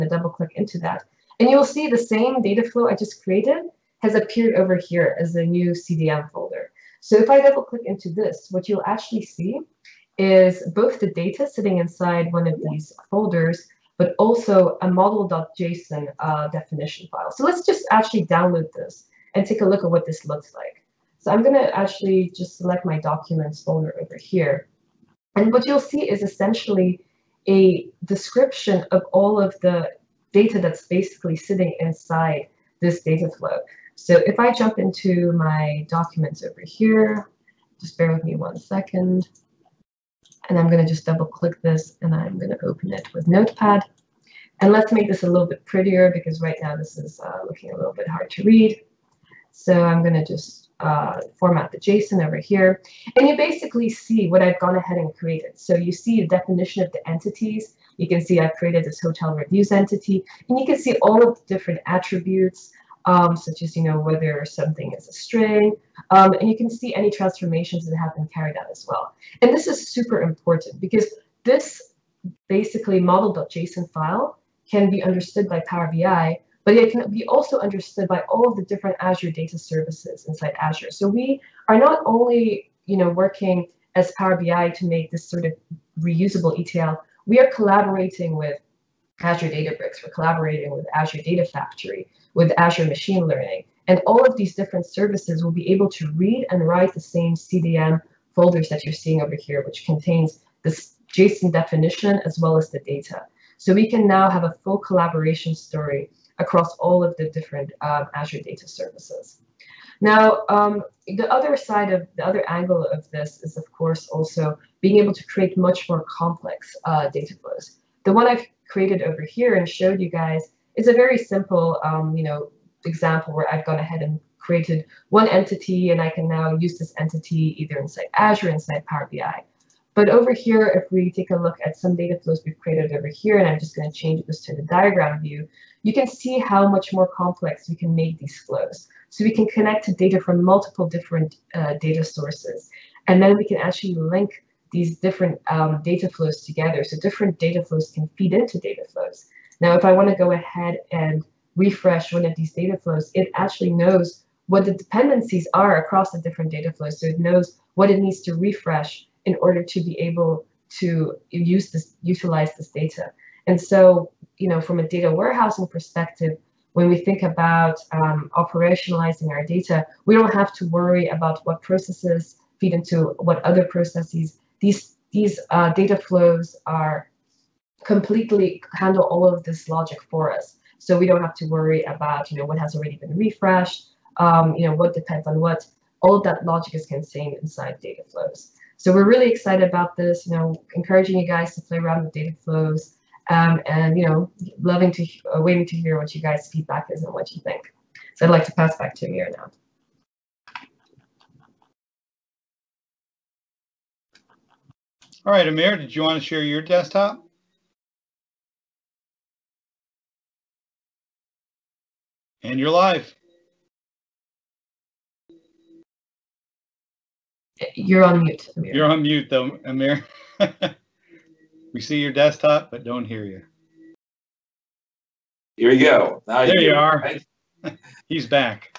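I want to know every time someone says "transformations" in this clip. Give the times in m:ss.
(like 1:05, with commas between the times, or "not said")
1:07.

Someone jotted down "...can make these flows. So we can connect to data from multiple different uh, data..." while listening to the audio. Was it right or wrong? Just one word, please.
right.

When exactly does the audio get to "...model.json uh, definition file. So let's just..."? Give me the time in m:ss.
0:14.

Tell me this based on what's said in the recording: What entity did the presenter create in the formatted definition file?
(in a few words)
hotel reviews.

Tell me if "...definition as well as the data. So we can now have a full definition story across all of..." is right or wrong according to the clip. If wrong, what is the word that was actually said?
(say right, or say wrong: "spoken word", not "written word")
wrong: "collaboration", not "definition".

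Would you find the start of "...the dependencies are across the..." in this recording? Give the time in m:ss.
2:34.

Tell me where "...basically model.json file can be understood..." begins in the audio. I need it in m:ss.
1:12.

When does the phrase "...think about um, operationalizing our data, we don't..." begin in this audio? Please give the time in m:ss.
2:46.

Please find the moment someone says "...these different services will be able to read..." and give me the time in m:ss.
1:34.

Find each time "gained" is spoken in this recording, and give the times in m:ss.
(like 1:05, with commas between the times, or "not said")
not said.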